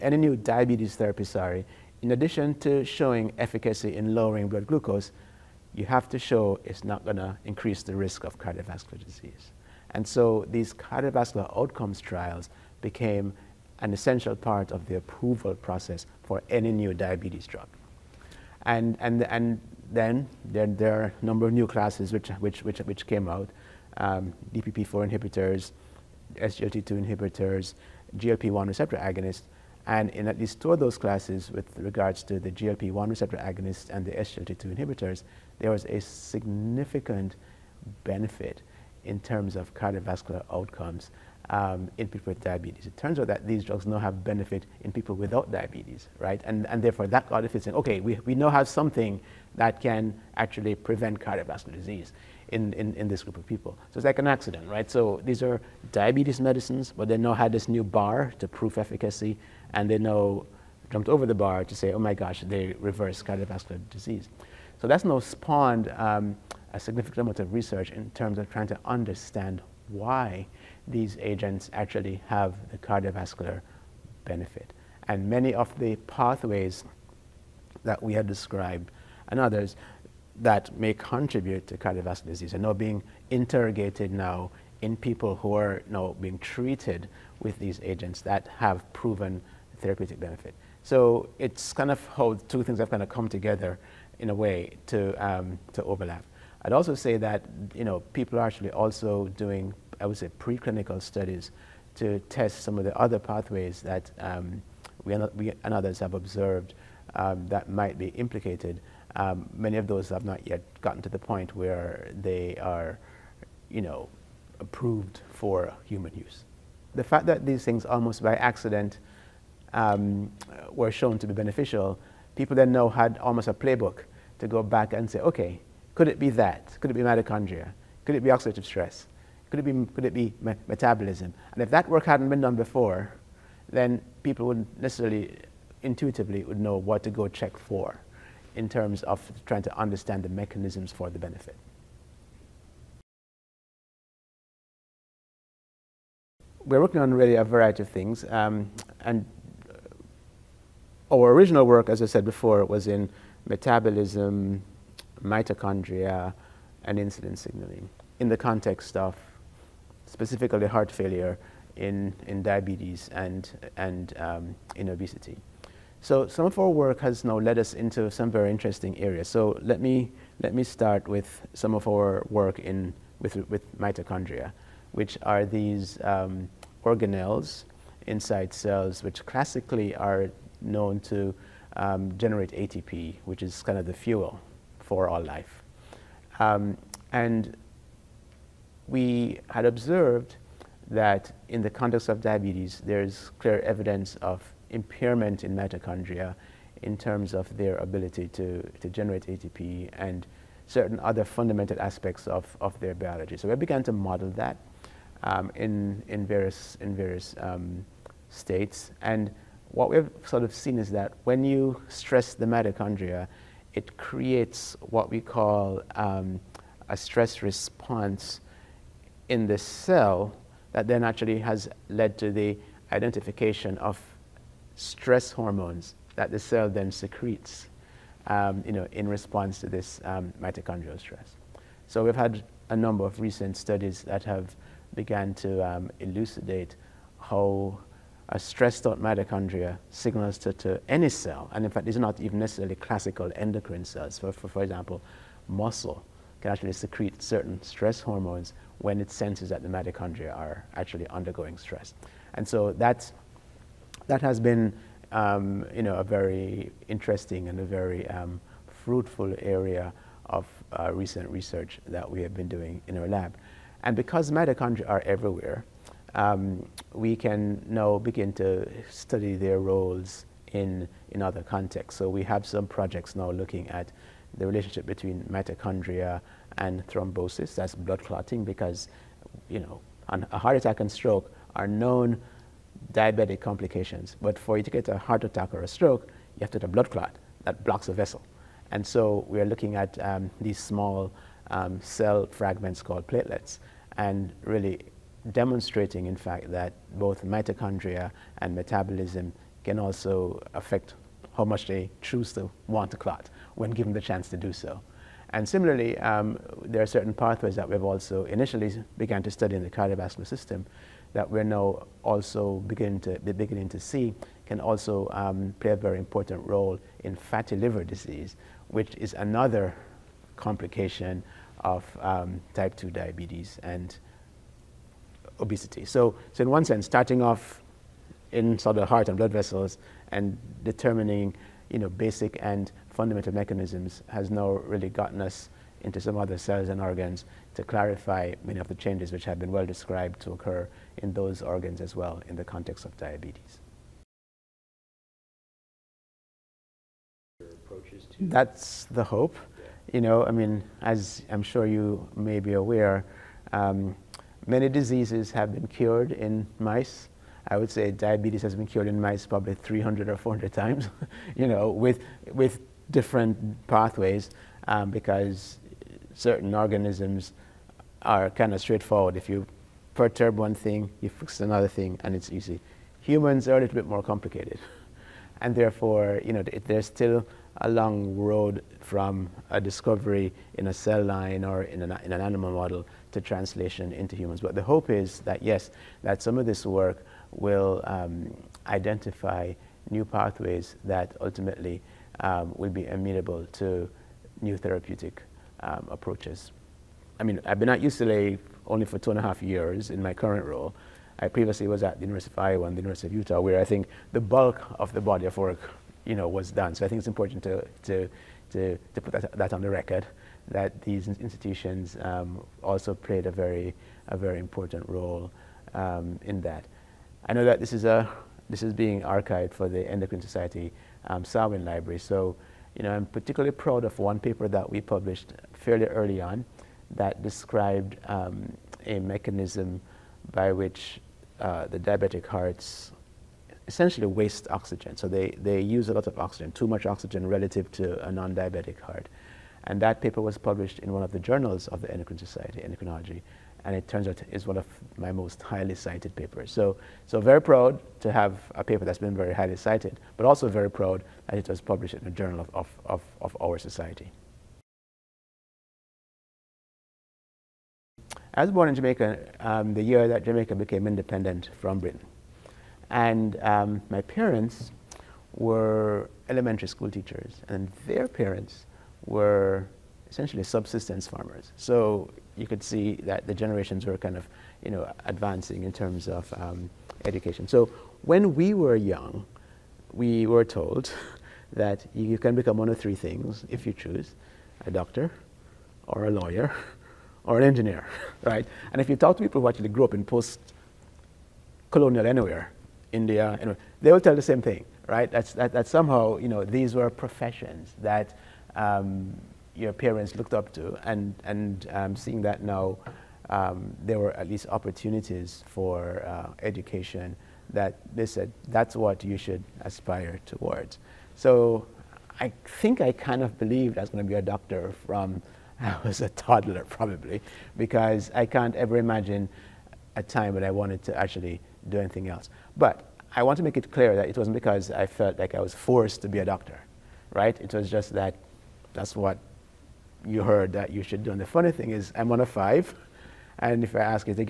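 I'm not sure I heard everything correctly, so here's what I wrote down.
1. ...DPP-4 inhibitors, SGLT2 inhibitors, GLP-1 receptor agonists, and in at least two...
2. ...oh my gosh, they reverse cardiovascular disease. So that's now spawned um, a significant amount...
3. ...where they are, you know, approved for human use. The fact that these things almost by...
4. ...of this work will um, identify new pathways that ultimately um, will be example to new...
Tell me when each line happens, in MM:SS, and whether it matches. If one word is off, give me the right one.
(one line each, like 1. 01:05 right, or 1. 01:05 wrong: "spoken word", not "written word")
1. 00:24 right
2. 01:01 right
3. 01:51 right
4. 06:26 wrong: "amenable", not "example".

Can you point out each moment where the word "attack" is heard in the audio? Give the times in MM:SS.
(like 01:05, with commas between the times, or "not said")
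04:40, 04:45.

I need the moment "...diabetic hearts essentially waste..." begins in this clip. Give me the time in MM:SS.
07:11.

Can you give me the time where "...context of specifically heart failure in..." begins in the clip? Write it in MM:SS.
02:38.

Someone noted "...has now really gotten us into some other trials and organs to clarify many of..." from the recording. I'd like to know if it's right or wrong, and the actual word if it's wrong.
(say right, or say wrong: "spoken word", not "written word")
wrong: "cells", not "trials".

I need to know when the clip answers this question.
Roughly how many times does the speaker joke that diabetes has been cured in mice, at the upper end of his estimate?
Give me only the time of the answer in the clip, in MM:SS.
06:00.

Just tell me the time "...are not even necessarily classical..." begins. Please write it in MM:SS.
04:01.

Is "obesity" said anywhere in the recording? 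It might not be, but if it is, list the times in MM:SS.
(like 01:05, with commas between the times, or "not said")
02:44, 05:25.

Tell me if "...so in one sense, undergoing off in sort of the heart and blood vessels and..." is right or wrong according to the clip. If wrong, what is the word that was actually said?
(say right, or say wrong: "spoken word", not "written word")
wrong: "starting", not "undergoing".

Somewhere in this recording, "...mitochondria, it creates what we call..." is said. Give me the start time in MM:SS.
03:32.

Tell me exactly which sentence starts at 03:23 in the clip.
So we began to model that um, in, in various, in various um, states.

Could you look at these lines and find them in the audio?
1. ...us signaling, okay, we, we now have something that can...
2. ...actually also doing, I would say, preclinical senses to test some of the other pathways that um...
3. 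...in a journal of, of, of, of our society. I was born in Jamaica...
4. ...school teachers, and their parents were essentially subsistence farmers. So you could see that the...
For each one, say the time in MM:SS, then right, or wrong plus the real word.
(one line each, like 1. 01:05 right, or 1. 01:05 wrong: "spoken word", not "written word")
1. 00:47 wrong: "saying", not "signaling"
2. 01:38 wrong: "studies", not "senses"
3. 07:31 right
4. 07:46 right.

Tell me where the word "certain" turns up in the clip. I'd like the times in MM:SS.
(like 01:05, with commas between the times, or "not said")
03:20, 04:07, 05:06, 06:06.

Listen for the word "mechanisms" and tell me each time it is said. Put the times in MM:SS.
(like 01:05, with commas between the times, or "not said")
02:20, 05:33, 07:08.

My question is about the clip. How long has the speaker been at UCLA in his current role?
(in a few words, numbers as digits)
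Two and a half years.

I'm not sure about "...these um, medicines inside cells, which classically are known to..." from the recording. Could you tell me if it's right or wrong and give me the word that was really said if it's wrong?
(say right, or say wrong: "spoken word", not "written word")
wrong: "organelles", not "medicines".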